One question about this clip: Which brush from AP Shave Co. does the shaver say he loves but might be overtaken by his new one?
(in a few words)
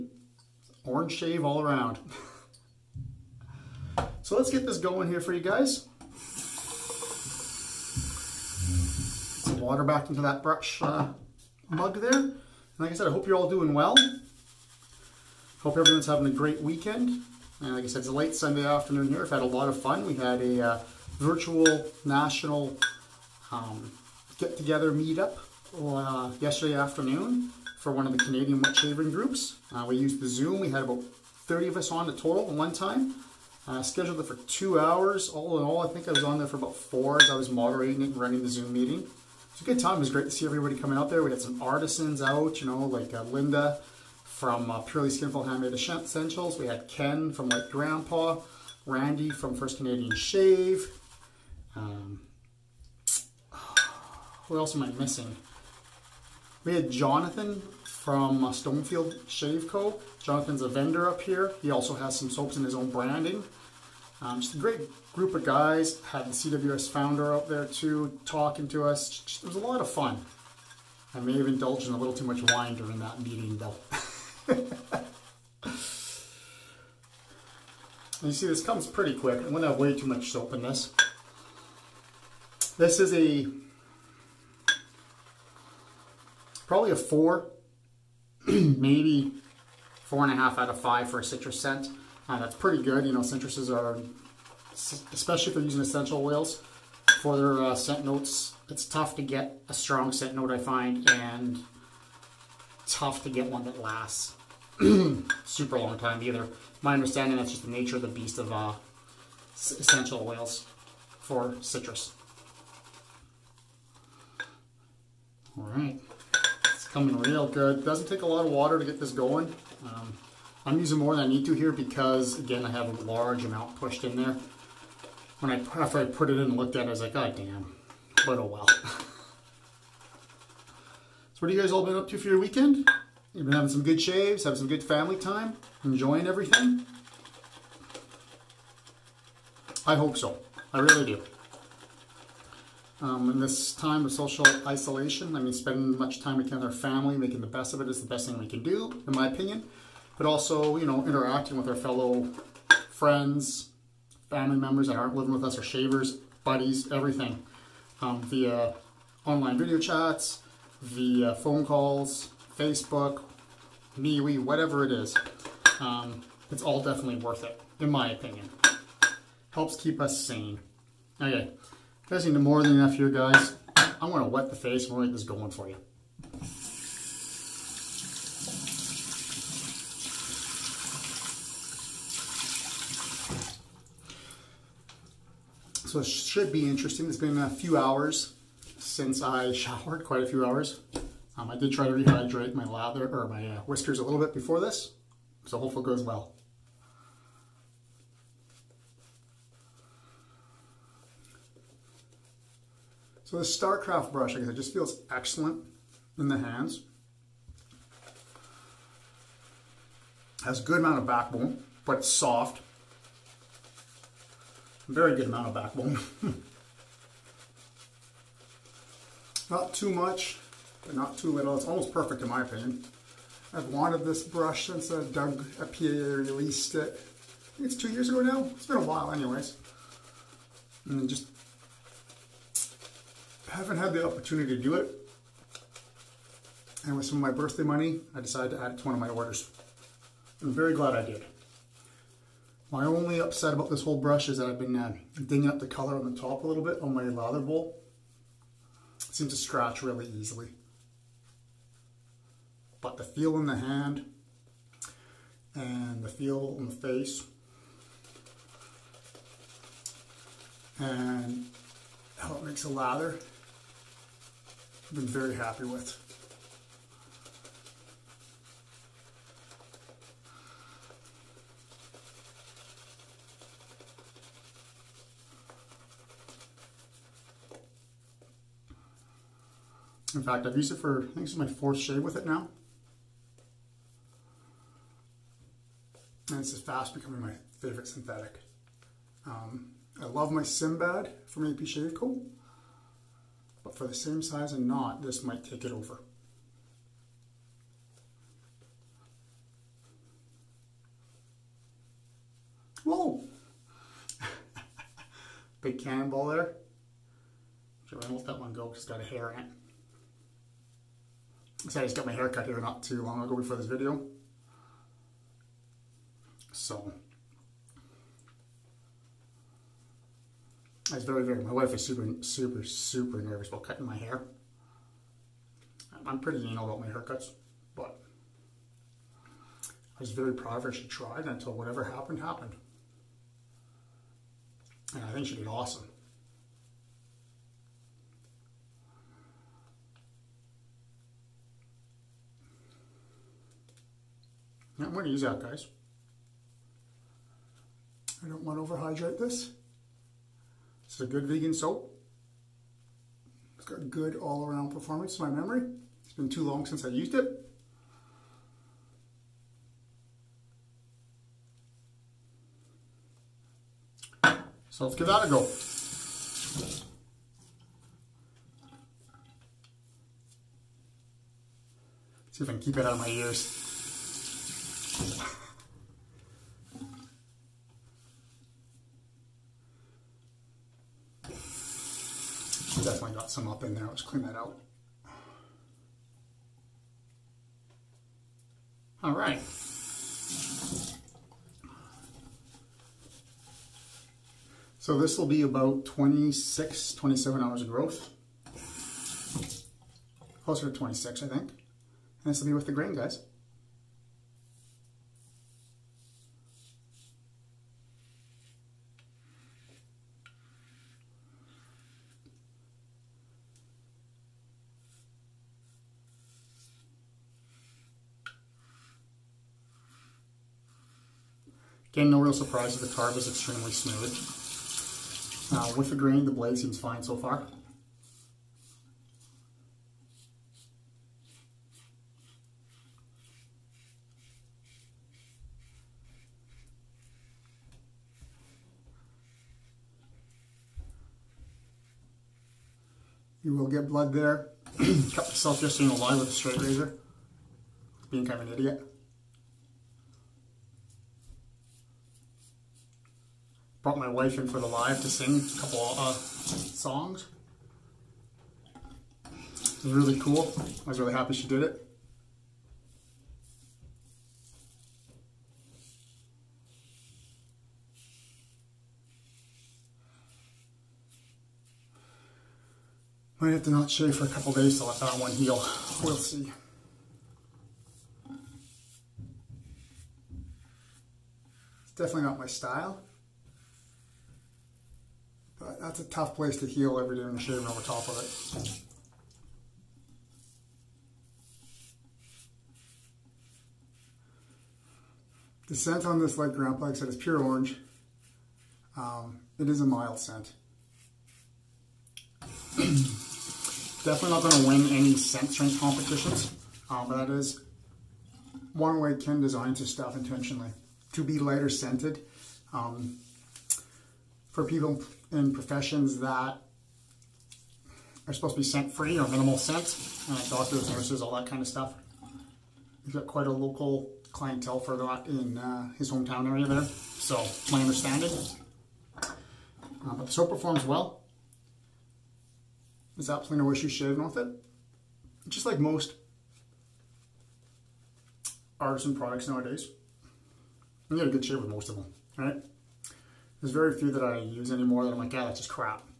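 Simbad.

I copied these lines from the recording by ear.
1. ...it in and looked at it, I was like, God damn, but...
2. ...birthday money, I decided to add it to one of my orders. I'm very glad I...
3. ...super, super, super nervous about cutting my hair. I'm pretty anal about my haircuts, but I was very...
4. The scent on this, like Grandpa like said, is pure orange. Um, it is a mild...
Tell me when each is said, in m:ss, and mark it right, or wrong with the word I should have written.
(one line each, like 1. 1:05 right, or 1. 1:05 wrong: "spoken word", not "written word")
1. 2:06 right
2. 3:57 right
3. 5:21 right
4. 8:15 right.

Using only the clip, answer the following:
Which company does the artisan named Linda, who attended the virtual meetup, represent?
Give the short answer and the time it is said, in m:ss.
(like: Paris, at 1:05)
Purely Skinful Handmade Essentials, at 0:44.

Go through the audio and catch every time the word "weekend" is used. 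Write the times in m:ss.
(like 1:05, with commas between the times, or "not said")
0:16, 2:12.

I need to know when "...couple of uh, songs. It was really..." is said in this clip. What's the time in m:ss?
7:35.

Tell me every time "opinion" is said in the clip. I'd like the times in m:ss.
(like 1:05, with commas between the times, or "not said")
2:29, 2:48, 3:42.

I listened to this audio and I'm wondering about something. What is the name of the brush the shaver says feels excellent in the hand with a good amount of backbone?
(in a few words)
StarCraft.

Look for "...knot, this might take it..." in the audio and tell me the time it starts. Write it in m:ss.
4:54.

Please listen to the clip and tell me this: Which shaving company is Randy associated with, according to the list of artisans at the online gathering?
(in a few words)
First Canadian Shave.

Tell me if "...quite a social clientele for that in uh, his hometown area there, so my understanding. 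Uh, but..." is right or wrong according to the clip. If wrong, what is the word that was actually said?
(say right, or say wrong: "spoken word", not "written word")
wrong: "local", not "social".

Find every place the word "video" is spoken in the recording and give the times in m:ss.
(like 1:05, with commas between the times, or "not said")
2:39, 5:13.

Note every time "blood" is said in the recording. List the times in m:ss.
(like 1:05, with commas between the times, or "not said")
7:23.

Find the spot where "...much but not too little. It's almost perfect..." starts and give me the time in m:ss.
3:39.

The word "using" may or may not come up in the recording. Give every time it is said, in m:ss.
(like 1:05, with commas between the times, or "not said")
1:35, 2:00.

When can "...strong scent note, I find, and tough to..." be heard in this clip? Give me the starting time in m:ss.
1:39.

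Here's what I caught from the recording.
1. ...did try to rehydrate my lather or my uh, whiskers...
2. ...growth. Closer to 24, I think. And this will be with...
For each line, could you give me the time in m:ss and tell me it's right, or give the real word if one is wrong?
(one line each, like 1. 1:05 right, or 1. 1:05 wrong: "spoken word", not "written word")
1. 3:11 right
2. 6:37 wrong: "26", not "24".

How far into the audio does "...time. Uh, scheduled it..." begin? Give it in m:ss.
0:32.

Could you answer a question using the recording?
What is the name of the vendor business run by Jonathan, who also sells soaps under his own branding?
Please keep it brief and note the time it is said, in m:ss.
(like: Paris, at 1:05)
Stonefield Shave Co., at 0:58.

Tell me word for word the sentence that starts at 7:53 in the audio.
Might have to not shave for a couple days till I found one heel.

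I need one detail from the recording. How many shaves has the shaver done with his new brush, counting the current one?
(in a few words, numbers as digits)
4.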